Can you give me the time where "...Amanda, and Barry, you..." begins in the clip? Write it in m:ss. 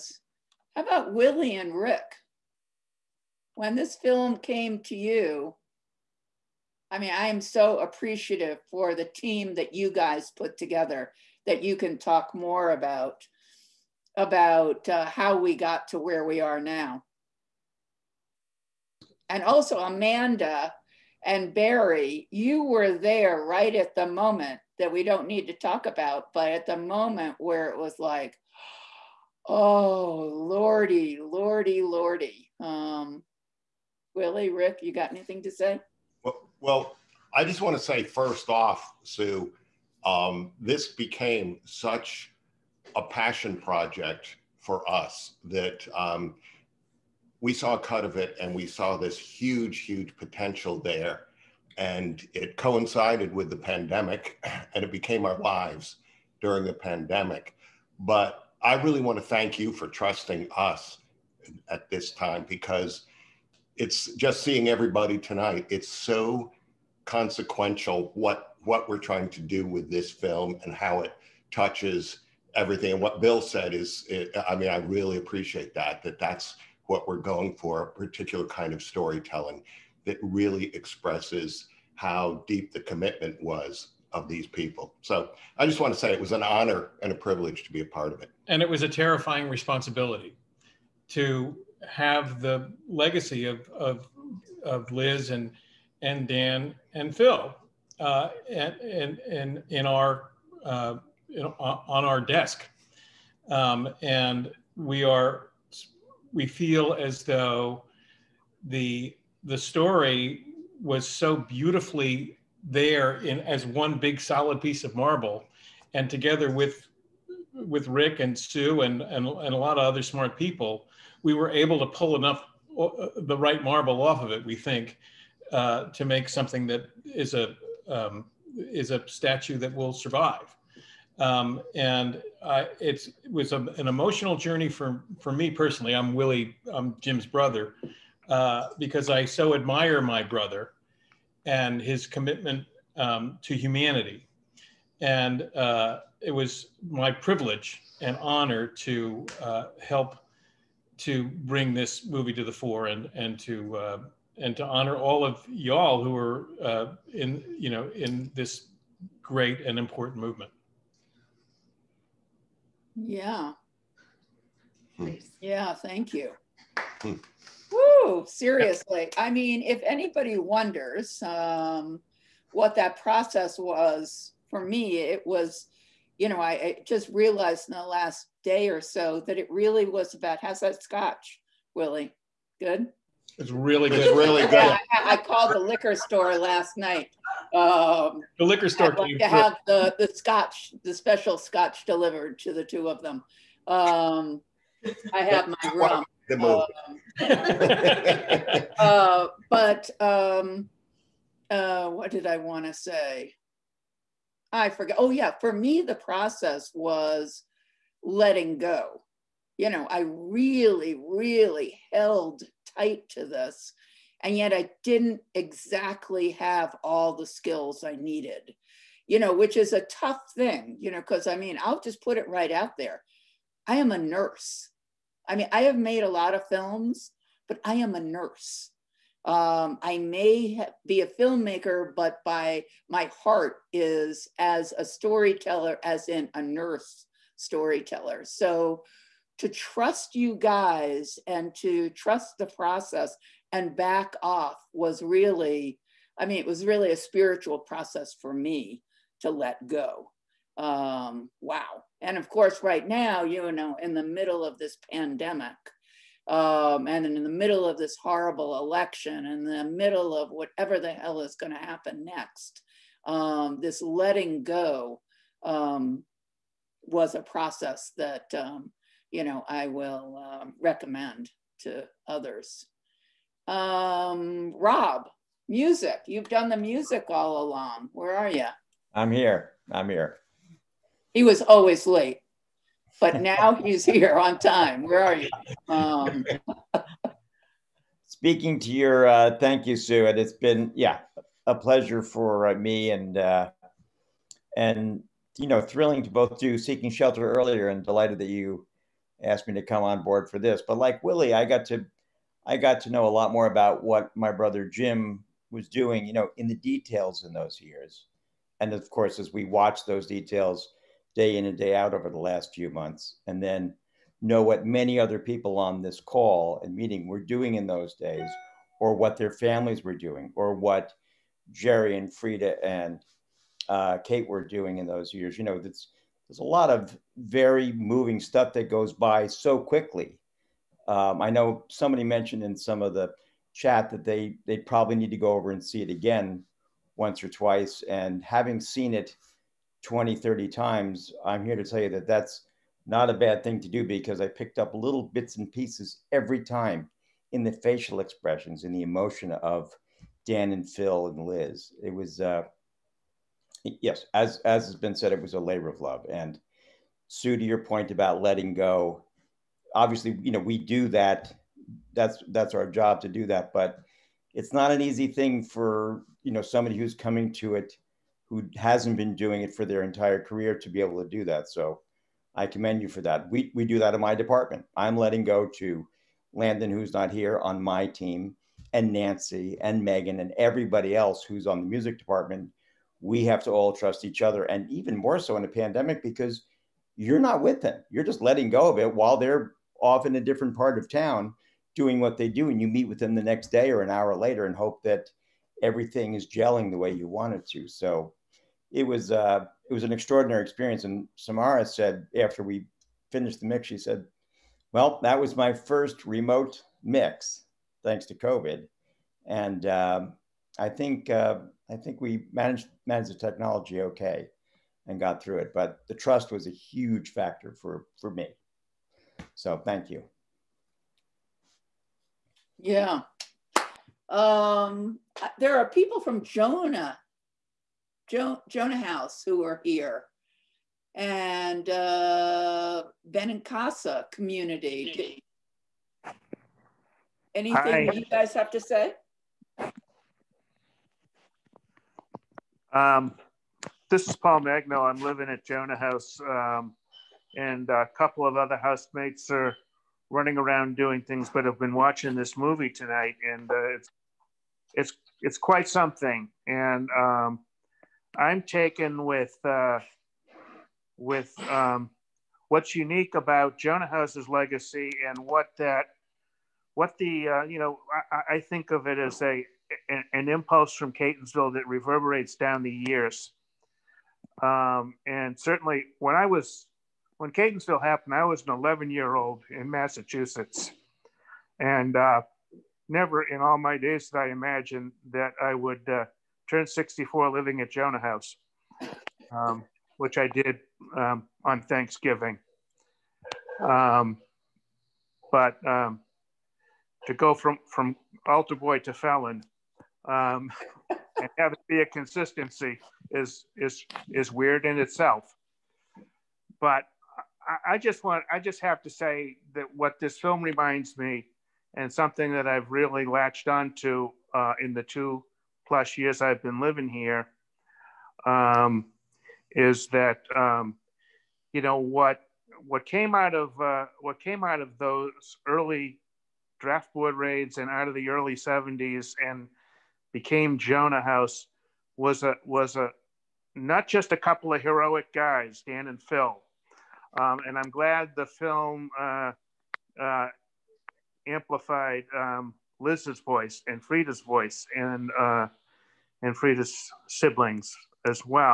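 0:19.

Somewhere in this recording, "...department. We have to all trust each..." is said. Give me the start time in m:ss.
6:21.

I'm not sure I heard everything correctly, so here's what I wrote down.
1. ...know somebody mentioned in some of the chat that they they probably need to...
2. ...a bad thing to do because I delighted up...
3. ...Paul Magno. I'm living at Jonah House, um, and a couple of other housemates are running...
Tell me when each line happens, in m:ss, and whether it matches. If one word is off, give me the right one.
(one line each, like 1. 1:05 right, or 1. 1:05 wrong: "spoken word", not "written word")
1. 5:31 right
2. 5:43 wrong: "picked", not "delighted"
3. 7:24 right.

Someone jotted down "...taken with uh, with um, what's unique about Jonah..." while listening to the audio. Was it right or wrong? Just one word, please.
right.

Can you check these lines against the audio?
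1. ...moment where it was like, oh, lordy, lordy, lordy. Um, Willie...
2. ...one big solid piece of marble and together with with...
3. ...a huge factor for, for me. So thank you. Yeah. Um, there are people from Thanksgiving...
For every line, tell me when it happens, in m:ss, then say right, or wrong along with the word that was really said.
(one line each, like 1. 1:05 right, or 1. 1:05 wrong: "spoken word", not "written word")
1. 0:26 right
2. 1:53 right
3. 6:56 wrong: "Jonah", not "Thanksgiving".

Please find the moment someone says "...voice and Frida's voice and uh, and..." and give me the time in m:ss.
9:03.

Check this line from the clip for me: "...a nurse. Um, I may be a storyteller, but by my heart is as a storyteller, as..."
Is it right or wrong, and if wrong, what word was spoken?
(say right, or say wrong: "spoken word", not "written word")
wrong: "filmmaker", not "storyteller".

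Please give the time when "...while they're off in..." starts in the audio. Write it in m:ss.
6:28.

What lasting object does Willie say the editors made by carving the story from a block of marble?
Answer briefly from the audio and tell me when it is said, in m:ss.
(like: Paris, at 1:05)
A statue, at 2:09.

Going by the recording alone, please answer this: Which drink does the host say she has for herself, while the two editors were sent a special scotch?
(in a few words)
Rum.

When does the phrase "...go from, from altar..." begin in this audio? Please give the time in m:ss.
8:17.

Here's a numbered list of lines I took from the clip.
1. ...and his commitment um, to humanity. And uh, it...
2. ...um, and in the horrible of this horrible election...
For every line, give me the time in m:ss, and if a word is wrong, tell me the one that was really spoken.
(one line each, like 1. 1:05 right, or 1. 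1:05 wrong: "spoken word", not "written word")
1. 2:21 right
2. 4:16 wrong: "middle", not "horrible".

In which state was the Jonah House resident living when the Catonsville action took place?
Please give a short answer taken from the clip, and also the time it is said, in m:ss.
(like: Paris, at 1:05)
Massachusetts, at 7:59.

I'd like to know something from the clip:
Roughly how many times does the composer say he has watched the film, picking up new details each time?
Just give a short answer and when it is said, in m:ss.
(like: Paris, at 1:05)
20 or 30, at 5:39.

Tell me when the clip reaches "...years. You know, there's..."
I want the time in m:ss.
5:25.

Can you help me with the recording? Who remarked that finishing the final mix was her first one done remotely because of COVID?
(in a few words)
Samara.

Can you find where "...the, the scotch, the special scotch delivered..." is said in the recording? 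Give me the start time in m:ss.
3:09.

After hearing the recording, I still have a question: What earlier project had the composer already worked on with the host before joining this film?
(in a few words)
Seeking Shelter.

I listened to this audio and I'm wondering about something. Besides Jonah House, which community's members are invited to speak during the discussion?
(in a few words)
Casa.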